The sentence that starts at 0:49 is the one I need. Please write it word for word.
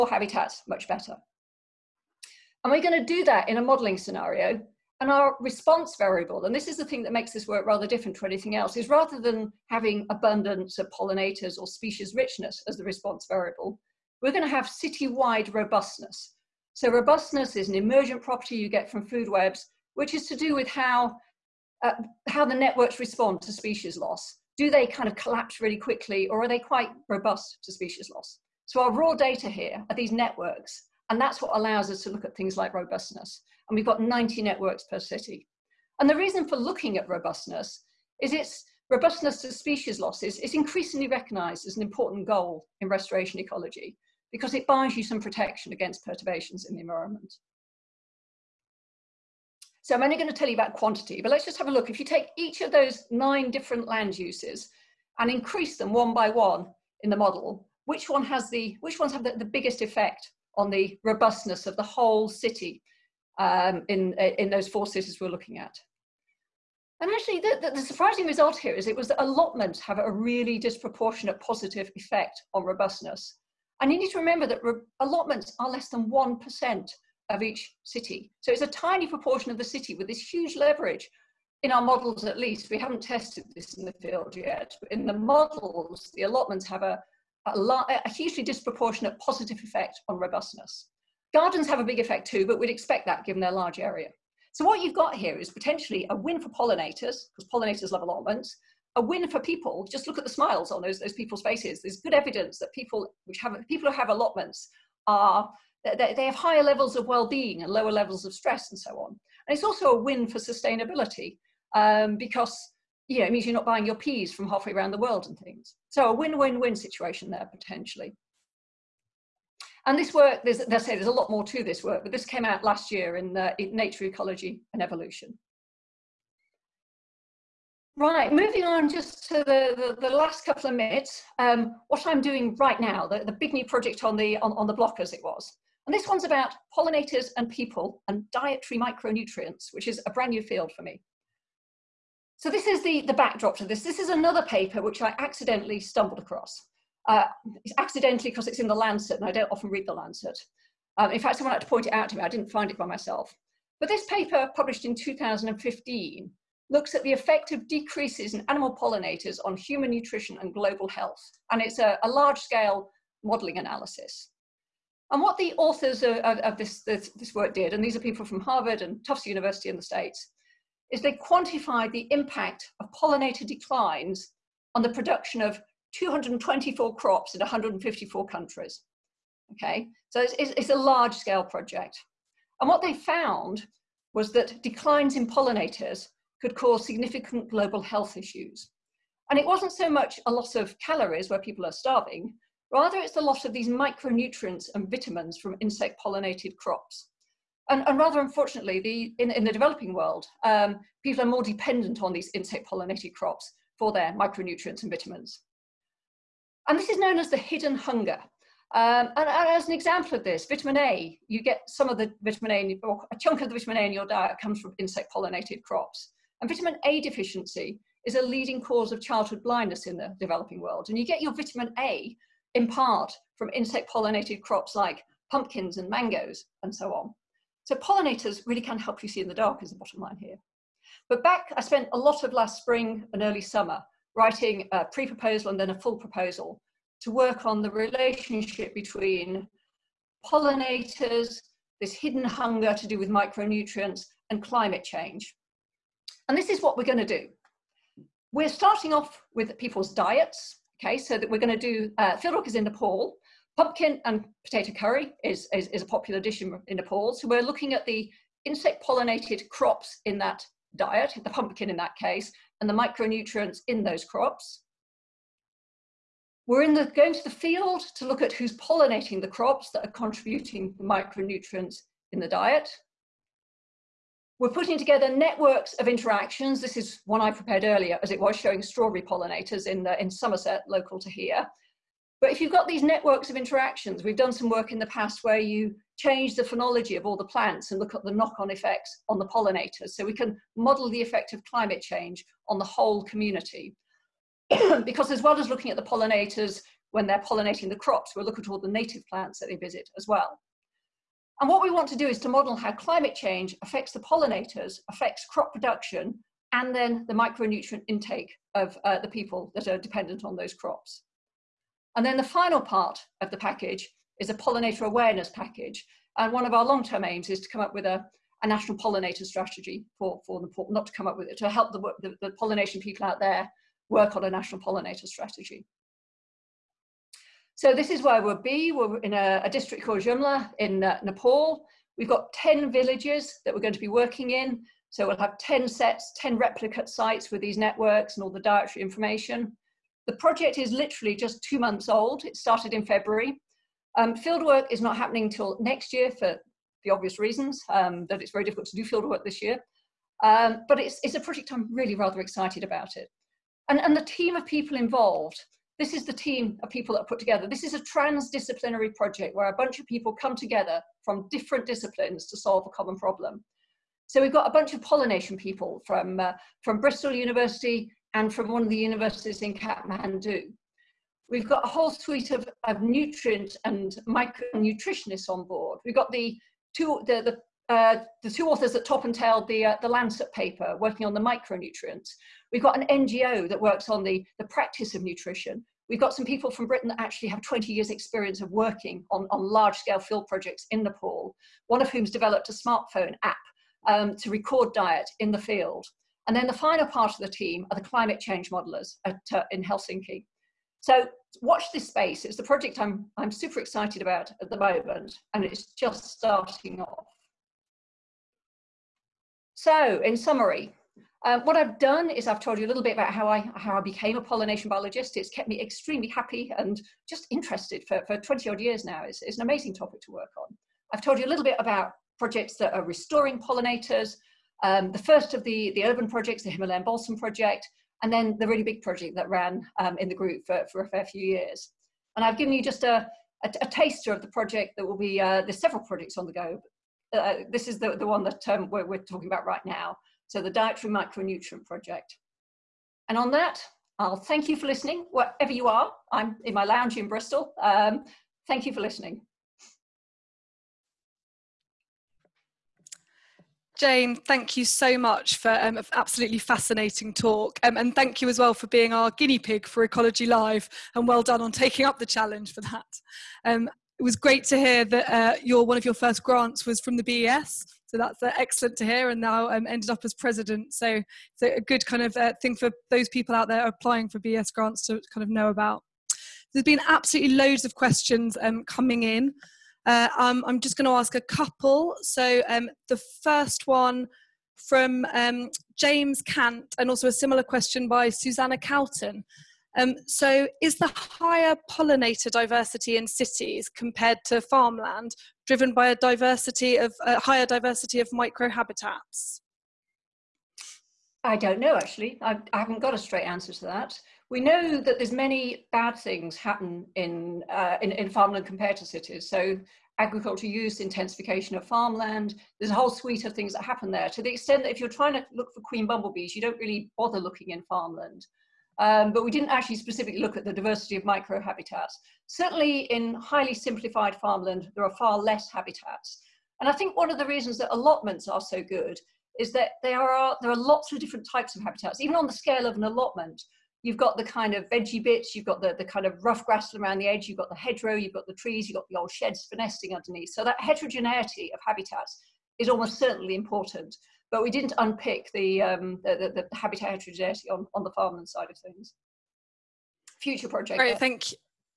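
So I'm only going to tell you about quantity, but let's just have a look.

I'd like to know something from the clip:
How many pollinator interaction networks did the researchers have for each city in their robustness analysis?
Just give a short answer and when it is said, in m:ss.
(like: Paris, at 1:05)
90, at 0:33.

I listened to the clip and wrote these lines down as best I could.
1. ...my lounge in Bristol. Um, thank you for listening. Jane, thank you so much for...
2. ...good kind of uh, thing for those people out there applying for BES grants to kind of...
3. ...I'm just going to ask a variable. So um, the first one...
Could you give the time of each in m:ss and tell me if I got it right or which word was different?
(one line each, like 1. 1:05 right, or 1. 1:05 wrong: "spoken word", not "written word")
1. 7:26 right
2. 7:51 right
3. 8:00 wrong: "couple", not "variable".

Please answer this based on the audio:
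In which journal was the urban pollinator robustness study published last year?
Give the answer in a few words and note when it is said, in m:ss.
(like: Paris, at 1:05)
Nature Ecology and Evolution, at 2:03.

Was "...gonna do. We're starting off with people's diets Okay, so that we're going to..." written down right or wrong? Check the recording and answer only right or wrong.
right.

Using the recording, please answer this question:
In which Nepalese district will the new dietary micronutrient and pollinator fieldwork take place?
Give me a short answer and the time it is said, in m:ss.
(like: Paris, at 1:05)
Jumla, at 5:29.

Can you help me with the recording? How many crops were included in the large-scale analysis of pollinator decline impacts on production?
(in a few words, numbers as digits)
224.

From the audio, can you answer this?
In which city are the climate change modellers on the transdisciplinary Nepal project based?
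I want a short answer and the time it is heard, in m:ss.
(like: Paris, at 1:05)
Helsinki, at 6:39.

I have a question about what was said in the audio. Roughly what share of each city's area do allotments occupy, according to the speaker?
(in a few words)
Less than 1%.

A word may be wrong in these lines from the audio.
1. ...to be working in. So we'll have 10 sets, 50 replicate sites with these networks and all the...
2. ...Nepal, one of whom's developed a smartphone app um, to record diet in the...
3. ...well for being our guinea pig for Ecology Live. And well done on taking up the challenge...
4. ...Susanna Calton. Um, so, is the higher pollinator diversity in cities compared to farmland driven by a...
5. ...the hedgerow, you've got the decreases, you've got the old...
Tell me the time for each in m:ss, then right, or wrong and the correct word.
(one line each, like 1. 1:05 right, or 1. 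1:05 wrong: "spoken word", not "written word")
1. 5:33 wrong: "10", not "50"
2. 6:30 right
3. 7:38 right
4. 8:08 right
5. 8:57 wrong: "trees", not "decreases".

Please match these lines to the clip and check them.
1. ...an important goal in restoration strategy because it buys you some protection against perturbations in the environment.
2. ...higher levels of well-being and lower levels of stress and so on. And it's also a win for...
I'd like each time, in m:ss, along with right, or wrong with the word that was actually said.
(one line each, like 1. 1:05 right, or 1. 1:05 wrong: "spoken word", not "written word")
1. 0:41 wrong: "ecology", not "strategy"
2. 1:46 right.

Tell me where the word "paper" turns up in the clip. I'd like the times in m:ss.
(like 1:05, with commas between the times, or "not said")
2:24, 2:34, 6:20.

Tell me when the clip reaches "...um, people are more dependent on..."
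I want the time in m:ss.
3:20.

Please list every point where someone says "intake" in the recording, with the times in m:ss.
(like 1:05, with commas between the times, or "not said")
5:07.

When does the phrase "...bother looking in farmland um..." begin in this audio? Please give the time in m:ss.
8:36.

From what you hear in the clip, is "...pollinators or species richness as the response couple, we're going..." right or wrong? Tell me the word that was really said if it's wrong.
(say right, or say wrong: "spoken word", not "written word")
wrong: "variable", not "couple".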